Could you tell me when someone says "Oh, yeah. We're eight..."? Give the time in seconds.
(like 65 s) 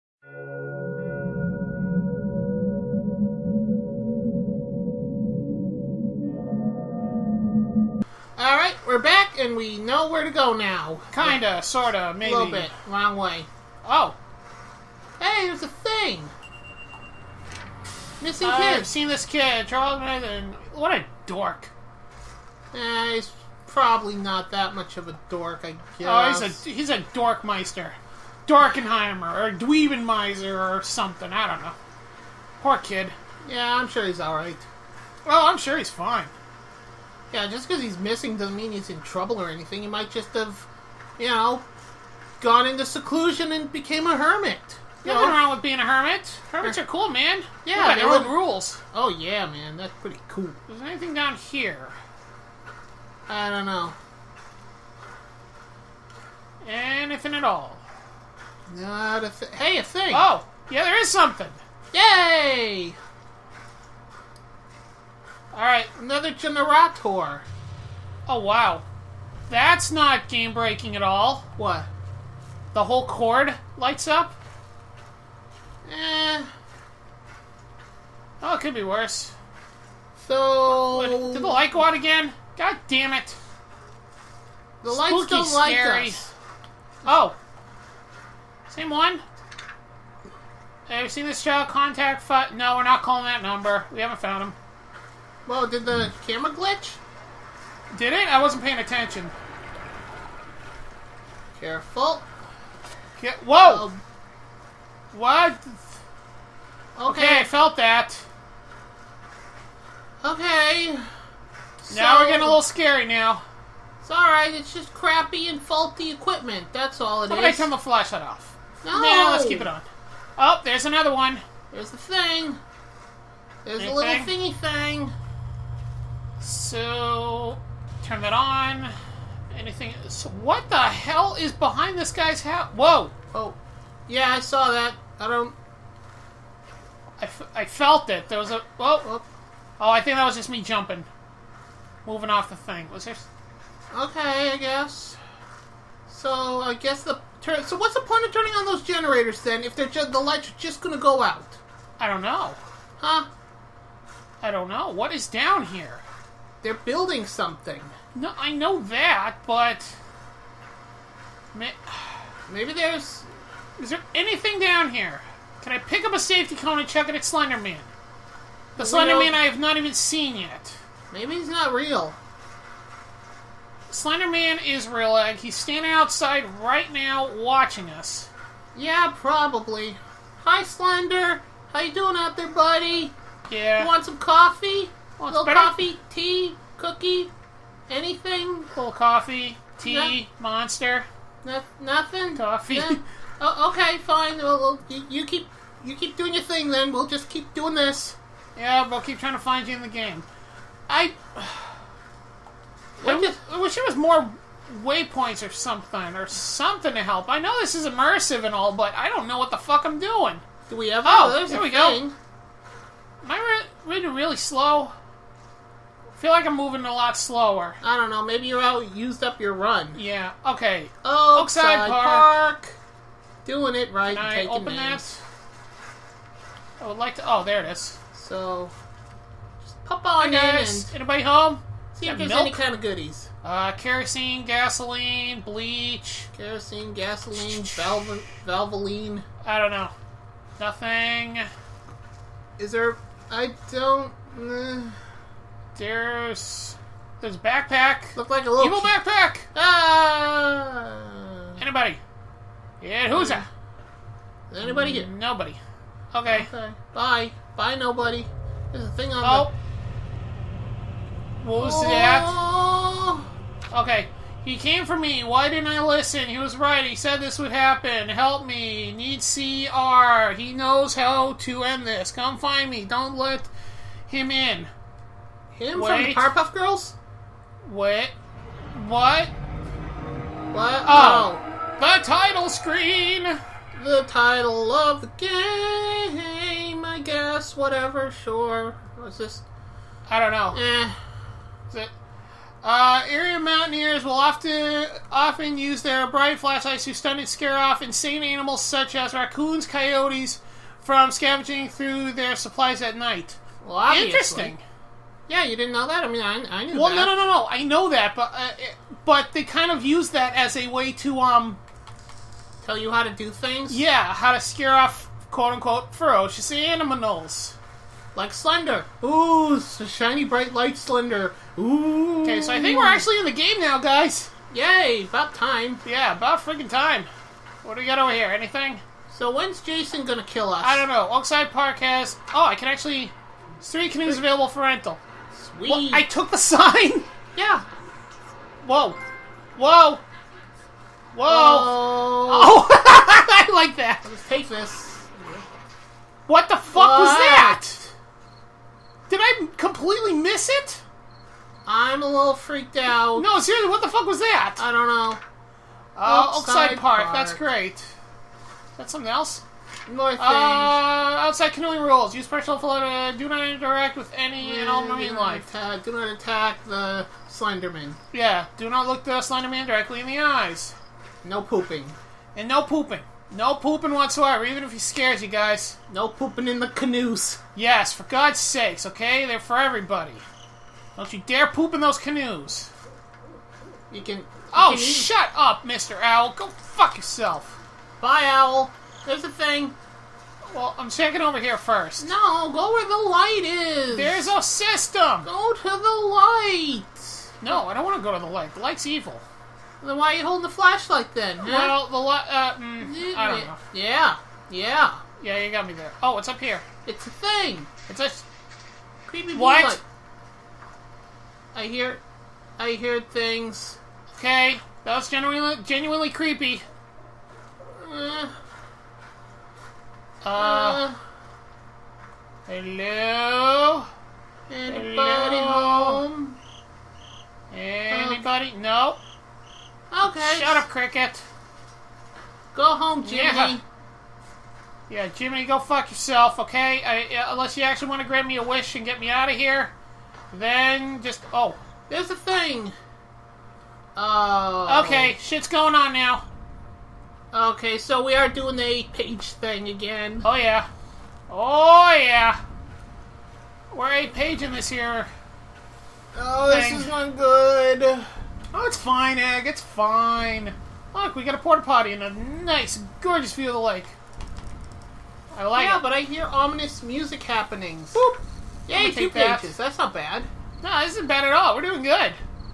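451 s.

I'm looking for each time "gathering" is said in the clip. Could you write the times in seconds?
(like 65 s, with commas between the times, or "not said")
not said.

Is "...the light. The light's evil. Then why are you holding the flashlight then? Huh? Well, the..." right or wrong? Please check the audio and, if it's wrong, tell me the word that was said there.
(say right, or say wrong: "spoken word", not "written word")
right.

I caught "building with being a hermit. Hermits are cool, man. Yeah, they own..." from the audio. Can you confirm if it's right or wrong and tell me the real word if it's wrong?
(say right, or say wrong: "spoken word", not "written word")
wrong: "wrong", not "building".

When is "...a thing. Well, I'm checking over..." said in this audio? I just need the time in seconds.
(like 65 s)
389 s.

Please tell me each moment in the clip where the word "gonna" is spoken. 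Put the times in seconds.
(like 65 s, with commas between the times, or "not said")
150 s, 330 s.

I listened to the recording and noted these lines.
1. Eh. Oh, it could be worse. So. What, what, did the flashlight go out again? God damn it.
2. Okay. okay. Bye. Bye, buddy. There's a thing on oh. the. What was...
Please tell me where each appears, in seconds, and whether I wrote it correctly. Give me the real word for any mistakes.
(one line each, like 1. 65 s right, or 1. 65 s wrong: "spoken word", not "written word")
1. 75 s wrong: "light", not "flashlight"
2. 256 s wrong: "nobody", not "buddy".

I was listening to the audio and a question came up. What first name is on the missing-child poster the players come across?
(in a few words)
Charles.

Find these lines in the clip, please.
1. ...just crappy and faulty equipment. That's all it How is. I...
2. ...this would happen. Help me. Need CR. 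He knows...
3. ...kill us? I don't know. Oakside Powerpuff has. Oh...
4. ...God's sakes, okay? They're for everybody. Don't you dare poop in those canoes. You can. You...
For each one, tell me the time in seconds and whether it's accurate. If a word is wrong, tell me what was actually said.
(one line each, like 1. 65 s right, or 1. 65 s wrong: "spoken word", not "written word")
1. 114 s right
2. 267 s right
3. 330 s wrong: "Park", not "Powerpuff"
4. 378 s right.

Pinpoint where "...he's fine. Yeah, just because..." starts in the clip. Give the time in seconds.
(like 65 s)
35 s.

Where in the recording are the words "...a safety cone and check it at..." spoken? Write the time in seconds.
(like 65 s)
166 s.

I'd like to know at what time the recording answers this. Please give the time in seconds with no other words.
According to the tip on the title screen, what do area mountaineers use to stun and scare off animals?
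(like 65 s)
296 s.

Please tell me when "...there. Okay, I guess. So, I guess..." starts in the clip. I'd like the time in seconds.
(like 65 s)
143 s.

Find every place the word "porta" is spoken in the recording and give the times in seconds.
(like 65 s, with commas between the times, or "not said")
461 s.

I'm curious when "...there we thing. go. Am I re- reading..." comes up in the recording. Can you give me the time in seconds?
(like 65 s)
211 s.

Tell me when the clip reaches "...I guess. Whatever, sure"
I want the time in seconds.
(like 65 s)
286 s.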